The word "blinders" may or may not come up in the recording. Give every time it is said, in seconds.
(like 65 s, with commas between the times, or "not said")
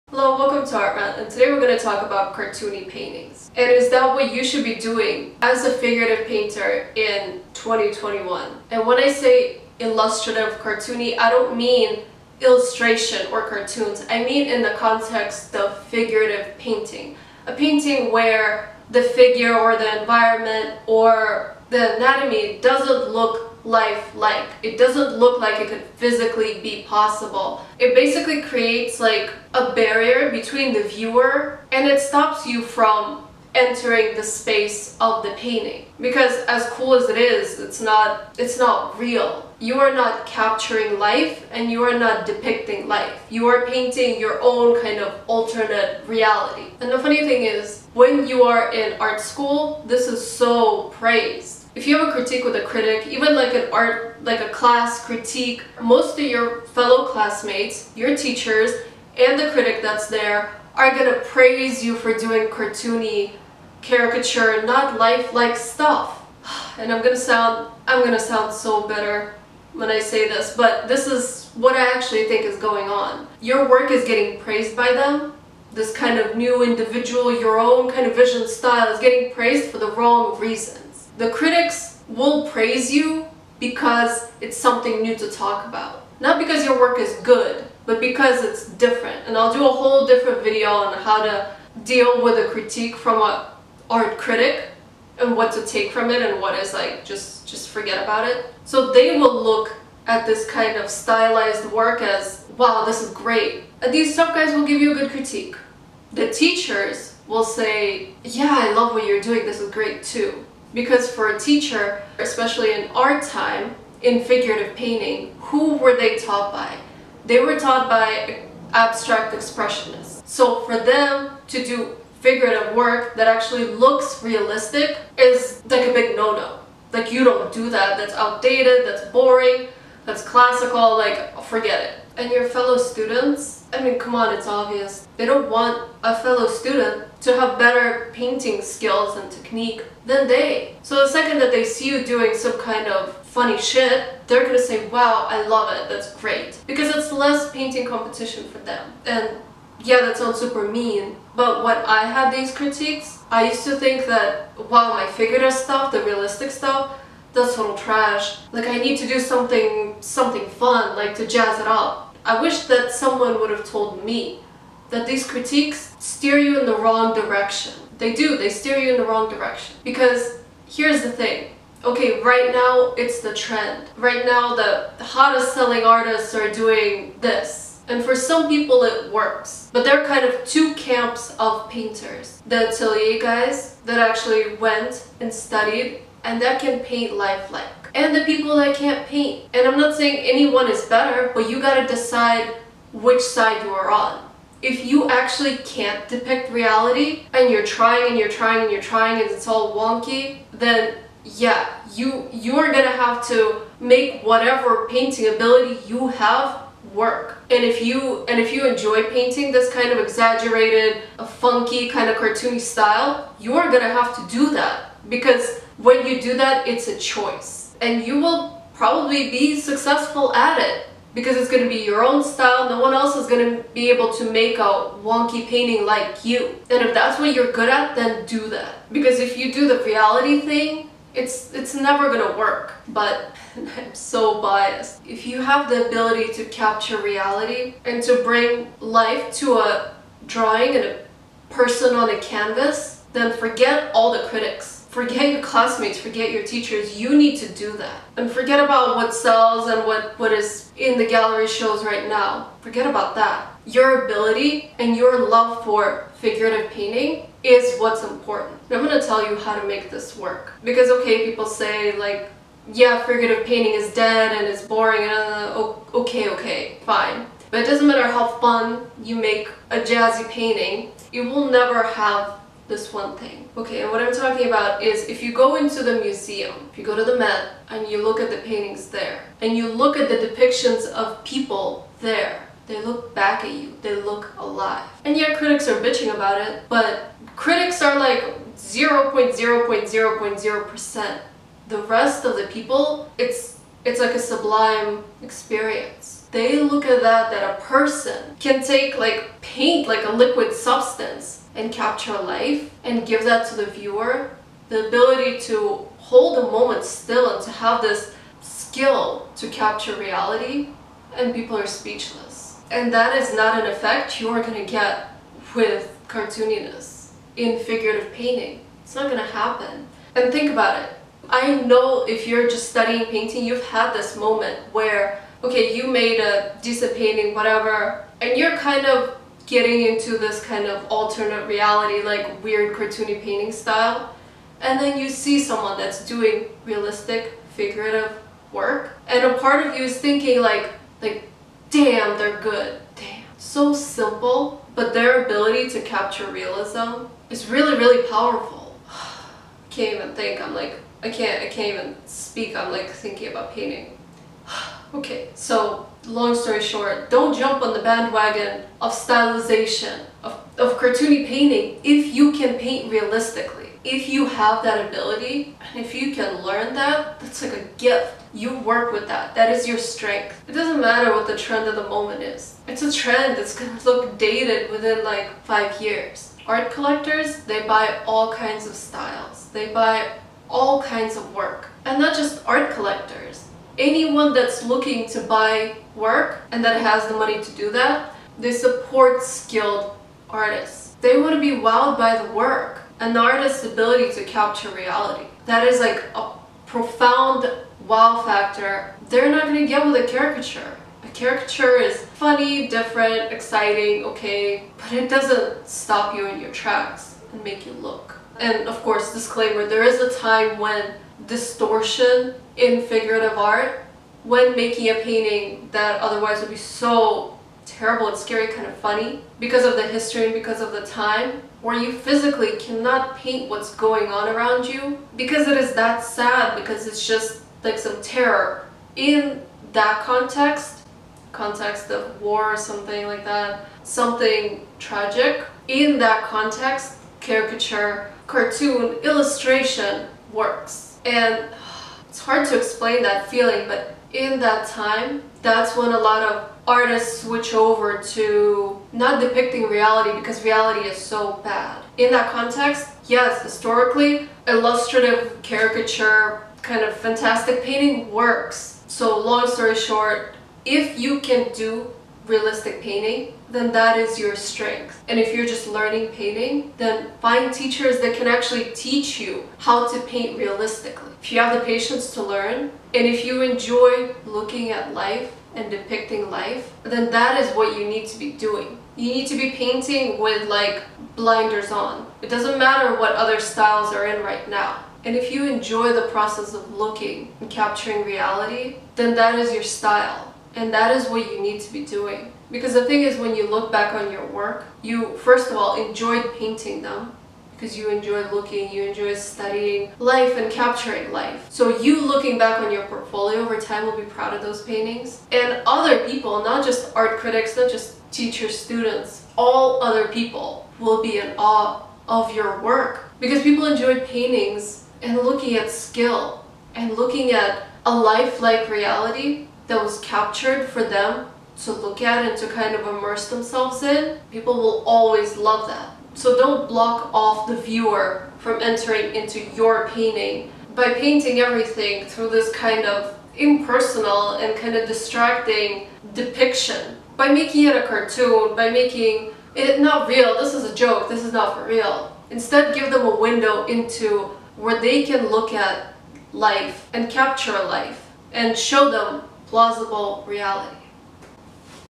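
481 s.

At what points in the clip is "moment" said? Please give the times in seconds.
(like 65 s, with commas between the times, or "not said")
306 s, 324 s, 371 s.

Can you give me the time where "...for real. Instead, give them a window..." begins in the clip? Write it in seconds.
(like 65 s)
541 s.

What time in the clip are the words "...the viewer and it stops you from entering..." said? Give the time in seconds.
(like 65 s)
30 s.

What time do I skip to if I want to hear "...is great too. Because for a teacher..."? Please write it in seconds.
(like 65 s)
109 s.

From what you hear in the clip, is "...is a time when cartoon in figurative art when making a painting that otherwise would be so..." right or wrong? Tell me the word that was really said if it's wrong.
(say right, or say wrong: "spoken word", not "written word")
wrong: "distortion", not "cartoon".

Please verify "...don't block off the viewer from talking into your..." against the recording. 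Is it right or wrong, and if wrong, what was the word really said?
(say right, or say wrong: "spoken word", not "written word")
wrong: "entering", not "talking".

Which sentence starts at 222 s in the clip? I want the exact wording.
No one else is going to be able to make a wonky painting like you.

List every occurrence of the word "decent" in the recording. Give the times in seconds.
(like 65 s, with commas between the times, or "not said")
326 s.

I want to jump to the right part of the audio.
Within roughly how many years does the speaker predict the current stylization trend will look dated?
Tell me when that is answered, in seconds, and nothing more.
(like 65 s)
375 s.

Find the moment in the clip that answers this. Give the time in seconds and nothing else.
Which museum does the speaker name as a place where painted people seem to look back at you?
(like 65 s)
277 s.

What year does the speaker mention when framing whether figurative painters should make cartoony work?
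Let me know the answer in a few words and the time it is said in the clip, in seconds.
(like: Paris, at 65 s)
2021, at 7 s.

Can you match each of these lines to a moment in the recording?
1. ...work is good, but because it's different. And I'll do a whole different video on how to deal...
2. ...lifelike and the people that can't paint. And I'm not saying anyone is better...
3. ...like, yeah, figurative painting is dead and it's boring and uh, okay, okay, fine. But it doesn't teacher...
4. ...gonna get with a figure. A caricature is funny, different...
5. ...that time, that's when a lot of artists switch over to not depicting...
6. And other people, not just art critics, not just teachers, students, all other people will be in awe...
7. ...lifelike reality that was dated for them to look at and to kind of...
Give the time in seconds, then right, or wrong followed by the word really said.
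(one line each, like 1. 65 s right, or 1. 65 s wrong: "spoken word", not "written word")
1. 86 s right
2. 187 s right
3. 261 s wrong: "matter", not "teacher"
4. 399 s wrong: "caricature", not "figure"
5. 444 s right
6. 505 s right
7. 517 s wrong: "captured", not "dated".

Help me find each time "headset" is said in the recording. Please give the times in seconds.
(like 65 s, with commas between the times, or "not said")
not said.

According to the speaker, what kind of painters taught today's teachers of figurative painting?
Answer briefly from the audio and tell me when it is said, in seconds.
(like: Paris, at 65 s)
Abstract expressionists, at 118 s.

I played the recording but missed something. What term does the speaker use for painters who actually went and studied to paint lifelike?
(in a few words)
The atelier guys.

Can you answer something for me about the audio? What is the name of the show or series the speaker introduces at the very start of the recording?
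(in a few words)
Art Rant.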